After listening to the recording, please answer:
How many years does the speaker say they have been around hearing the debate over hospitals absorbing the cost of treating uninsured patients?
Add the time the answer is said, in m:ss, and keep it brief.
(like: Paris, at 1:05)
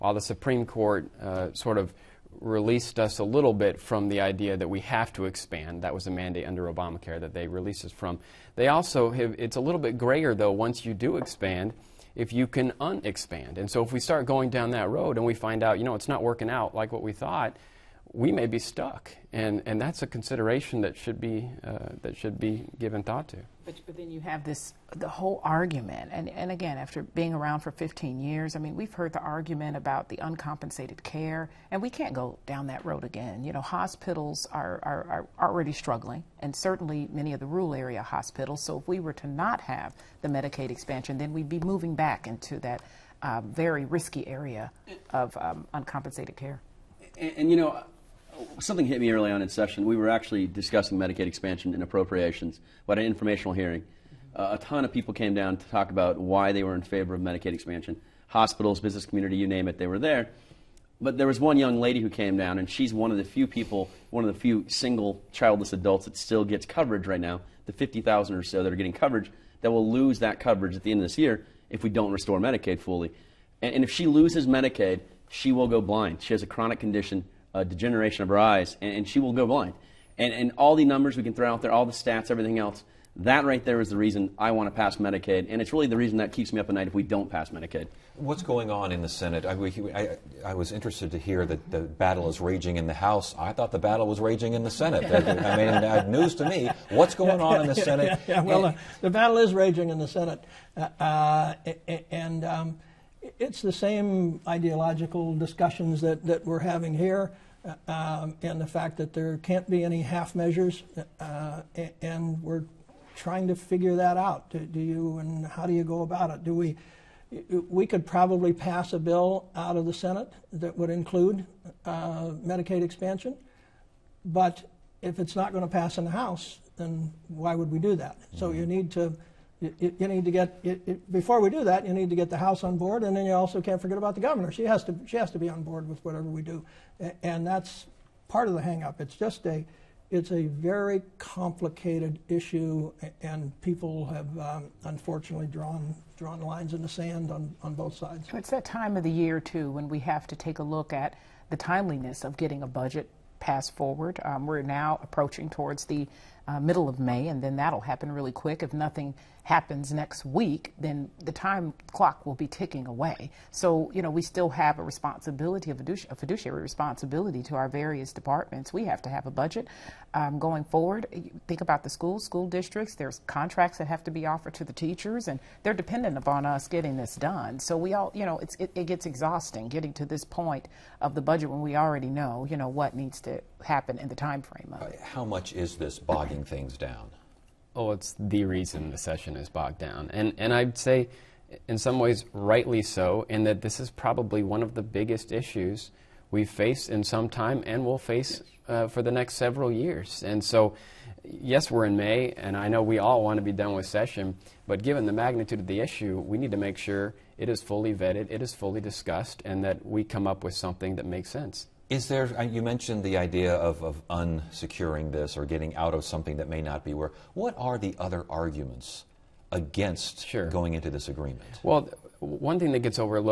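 15, at 0:27.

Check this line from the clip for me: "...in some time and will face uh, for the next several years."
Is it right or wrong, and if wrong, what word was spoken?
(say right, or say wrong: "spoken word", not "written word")
right.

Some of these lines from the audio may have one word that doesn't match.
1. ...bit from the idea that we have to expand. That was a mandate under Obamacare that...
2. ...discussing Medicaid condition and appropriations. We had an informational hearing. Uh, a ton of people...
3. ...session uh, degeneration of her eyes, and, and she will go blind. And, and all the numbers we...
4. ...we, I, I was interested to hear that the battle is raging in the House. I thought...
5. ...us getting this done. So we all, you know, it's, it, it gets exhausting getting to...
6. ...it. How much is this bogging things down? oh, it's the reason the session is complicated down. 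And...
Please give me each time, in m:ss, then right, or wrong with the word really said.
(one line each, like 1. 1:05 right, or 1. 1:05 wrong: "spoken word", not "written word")
1. 0:03 right
2. 0:50 wrong: "expansion", not "condition"
3. 1:16 wrong: "condition", not "session"
4. 1:29 right
5. 2:56 right
6. 3:04 wrong: "bogged", not "complicated".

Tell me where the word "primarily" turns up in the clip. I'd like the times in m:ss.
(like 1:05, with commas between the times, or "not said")
not said.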